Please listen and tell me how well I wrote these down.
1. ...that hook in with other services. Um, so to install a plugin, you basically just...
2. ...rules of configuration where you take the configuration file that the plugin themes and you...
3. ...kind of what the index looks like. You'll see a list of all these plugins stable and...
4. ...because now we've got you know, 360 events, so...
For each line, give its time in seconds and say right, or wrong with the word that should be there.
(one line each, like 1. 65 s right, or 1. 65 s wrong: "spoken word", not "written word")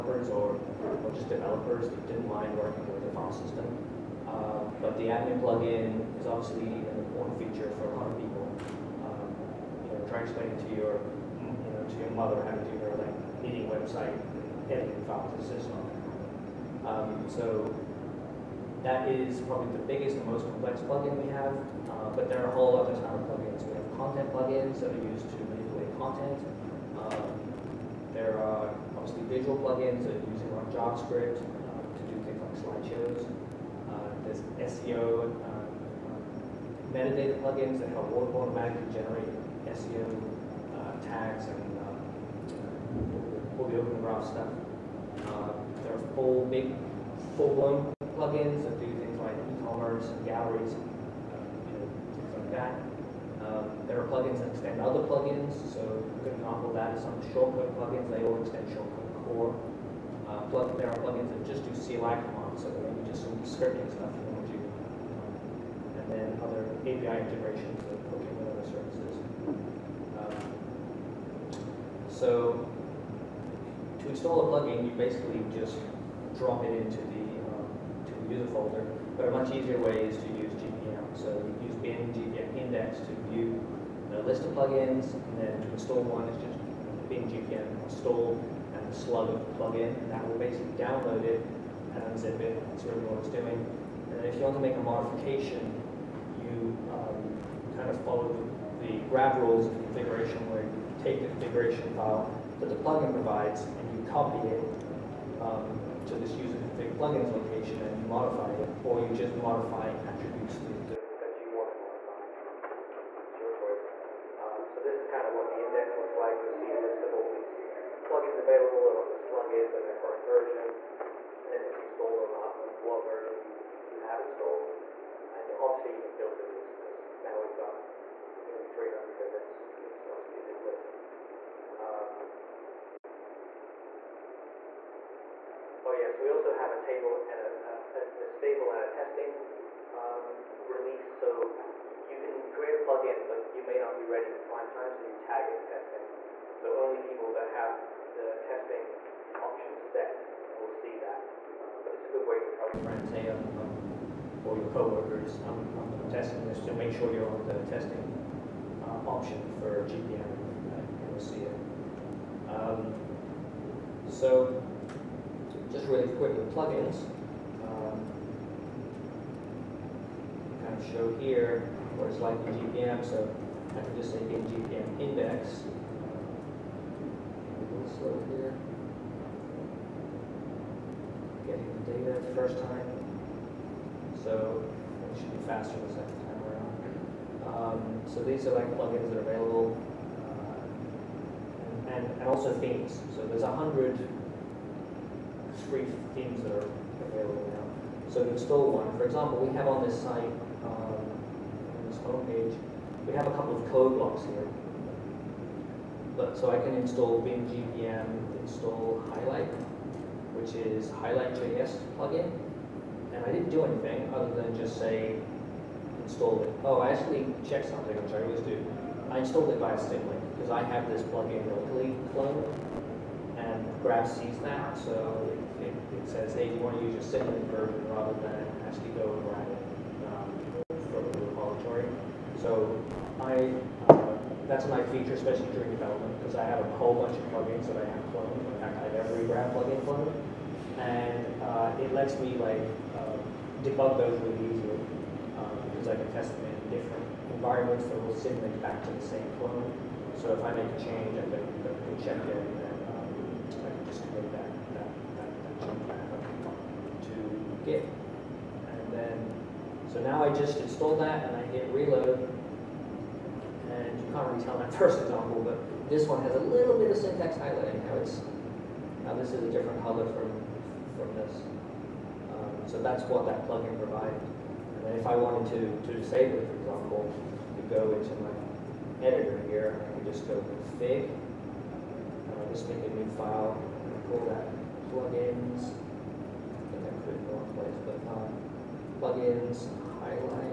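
1. 67 s right
2. 99 s wrong: "provides", not "themes"
3. 115 s wrong: "available", not "stable"
4. 126 s wrong: "300", not "360".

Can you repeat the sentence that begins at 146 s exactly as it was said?
So only people that have the testing option set will see that.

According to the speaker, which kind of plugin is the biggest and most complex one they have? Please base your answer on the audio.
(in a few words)
admin plugin.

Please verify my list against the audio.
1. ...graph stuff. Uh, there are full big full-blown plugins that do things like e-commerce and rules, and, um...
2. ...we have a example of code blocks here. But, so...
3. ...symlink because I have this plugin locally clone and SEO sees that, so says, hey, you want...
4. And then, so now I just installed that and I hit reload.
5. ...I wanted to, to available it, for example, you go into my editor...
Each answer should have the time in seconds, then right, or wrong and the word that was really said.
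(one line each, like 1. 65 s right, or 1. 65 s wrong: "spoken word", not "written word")
1. 43 s wrong: "galleries", not "rules"
2. 203 s wrong: "couple", not "example"
3. 219 s wrong: "Grav", not "SEO"
4. 257 s right
5. 275 s wrong: "disable", not "available".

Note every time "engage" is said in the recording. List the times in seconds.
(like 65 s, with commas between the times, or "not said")
not said.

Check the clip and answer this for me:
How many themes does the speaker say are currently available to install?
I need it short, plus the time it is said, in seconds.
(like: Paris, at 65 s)
103, at 193 s.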